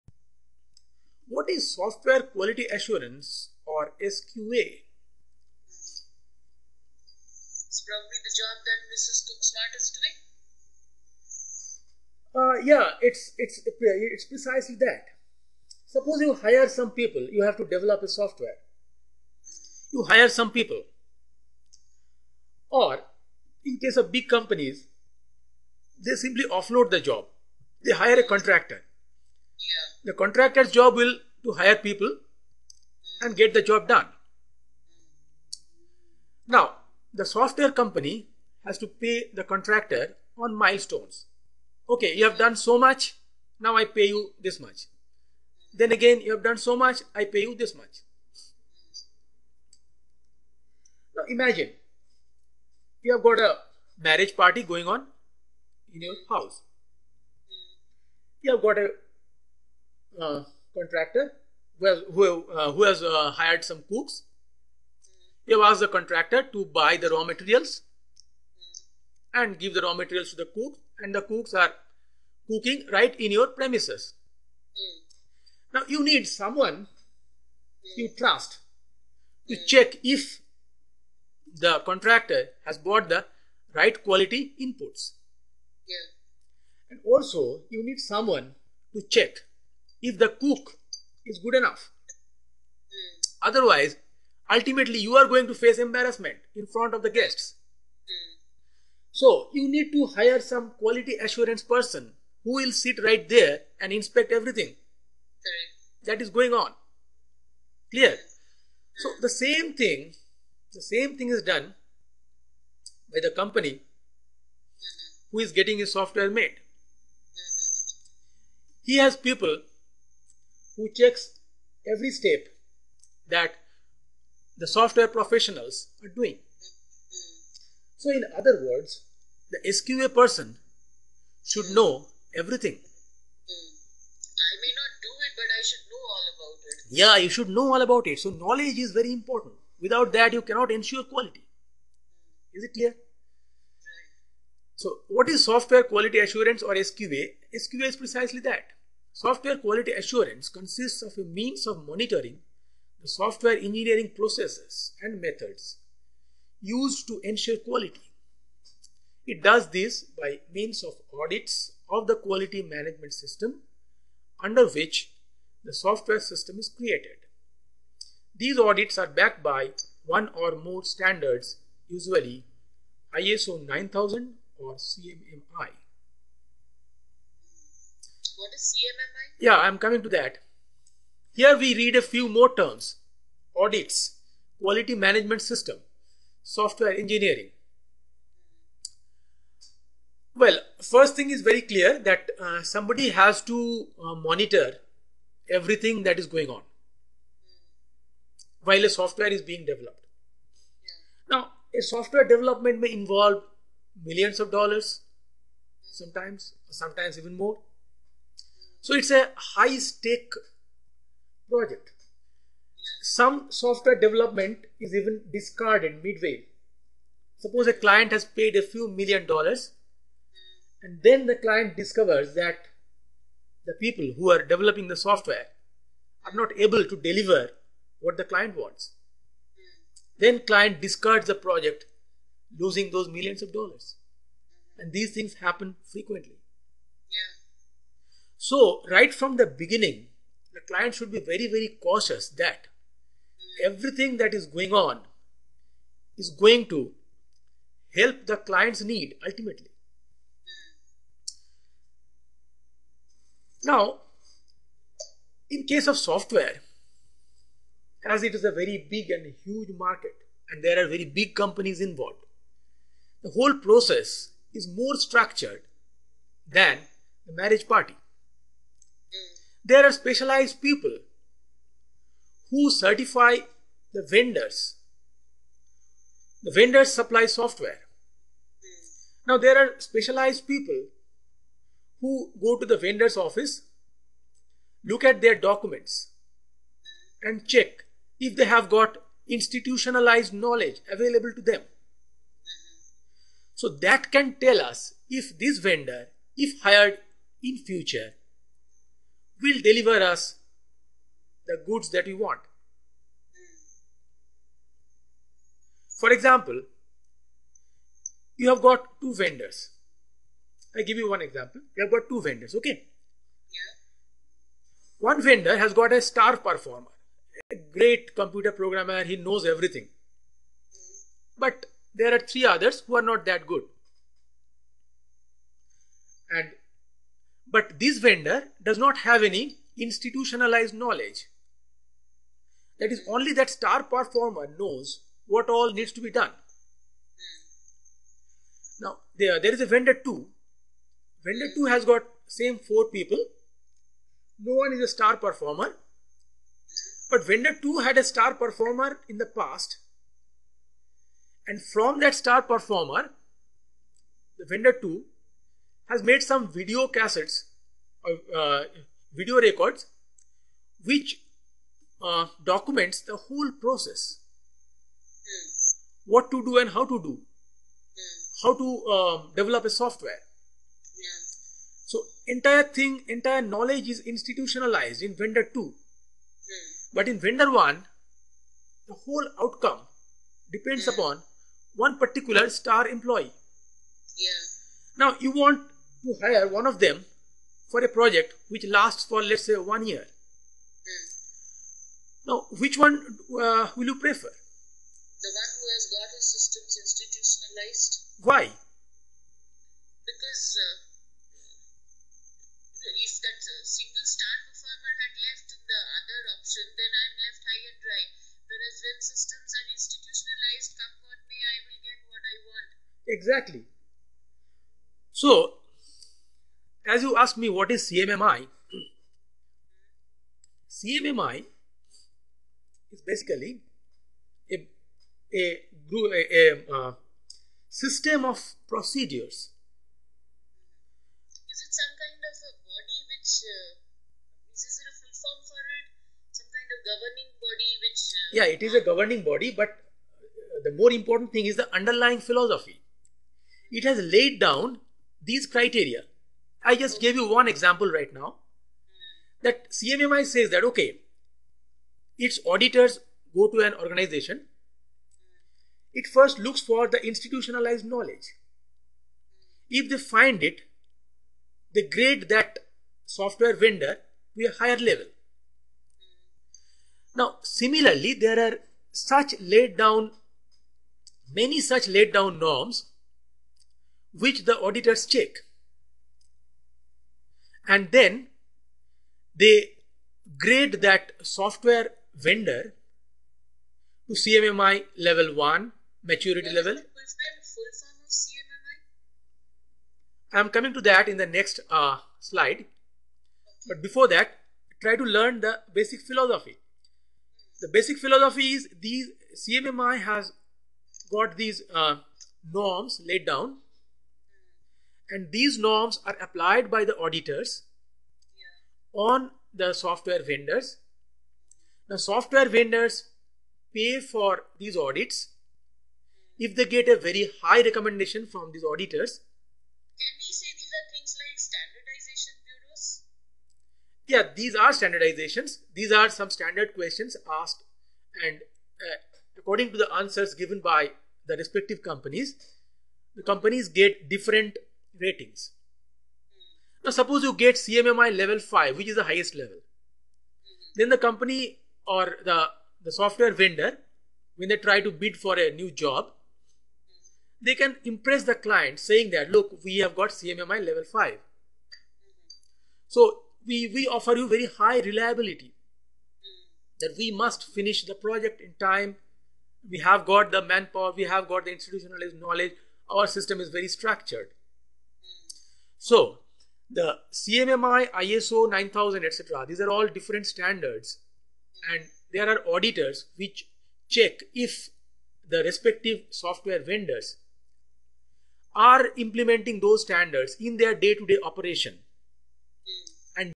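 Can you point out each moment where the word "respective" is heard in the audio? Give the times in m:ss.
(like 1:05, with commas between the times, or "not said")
8:51, 9:35.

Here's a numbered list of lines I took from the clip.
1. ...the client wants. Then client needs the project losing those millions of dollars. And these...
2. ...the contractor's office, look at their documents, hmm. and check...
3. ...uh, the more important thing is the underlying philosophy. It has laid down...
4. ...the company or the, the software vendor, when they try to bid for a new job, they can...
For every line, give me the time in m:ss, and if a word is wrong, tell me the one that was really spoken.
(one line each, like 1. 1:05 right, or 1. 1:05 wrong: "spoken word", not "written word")
1. 3:48 wrong: "discards", not "needs"
2. 4:42 wrong: "vendor", not "contractor"
3. 7:19 right
4. 9:00 right.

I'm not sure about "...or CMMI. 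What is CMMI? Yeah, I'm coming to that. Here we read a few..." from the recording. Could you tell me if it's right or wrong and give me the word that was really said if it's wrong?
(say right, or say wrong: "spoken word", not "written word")
right.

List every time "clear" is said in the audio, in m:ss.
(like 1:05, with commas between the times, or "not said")
1:47, 2:22, 3:11.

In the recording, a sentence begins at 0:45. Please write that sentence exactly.
Then again, you have done so much, I pay you this much.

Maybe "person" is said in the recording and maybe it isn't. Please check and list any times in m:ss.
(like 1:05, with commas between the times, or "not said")
1:41, 2:10.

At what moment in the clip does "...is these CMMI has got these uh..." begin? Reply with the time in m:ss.
8:18.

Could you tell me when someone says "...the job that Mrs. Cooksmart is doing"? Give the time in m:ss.
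0:08.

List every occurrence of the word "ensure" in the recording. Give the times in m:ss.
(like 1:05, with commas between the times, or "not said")
2:20, 2:37.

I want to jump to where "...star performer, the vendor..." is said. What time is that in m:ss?
5:52.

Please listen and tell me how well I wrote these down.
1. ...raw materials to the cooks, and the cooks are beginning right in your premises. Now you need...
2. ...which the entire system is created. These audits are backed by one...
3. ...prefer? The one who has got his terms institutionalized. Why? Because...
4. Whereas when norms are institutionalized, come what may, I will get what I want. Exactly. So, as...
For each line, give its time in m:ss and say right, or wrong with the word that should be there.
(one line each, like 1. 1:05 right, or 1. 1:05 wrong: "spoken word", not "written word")
1. 1:09 wrong: "cooking", not "beginning"
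2. 2:44 wrong: "software", not "entire"
3. 6:33 wrong: "systems", not "terms"
4. 6:48 wrong: "systems", not "norms".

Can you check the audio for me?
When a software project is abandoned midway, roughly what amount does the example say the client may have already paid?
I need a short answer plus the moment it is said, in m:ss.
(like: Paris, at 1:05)
A few million dollars, at 3:38.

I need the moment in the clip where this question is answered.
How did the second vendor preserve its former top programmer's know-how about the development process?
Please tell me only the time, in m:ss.
5:59.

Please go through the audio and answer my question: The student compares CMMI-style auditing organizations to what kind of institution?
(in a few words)
Standardization bureaus.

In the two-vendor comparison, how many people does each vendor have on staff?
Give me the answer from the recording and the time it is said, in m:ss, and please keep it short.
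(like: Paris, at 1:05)
4, at 5:42.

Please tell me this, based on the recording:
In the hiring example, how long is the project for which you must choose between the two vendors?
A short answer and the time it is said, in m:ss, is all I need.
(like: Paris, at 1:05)
1 year, at 6:29.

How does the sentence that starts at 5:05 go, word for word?
For example, you have got two vendors.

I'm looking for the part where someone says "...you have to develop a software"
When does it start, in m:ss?
0:17.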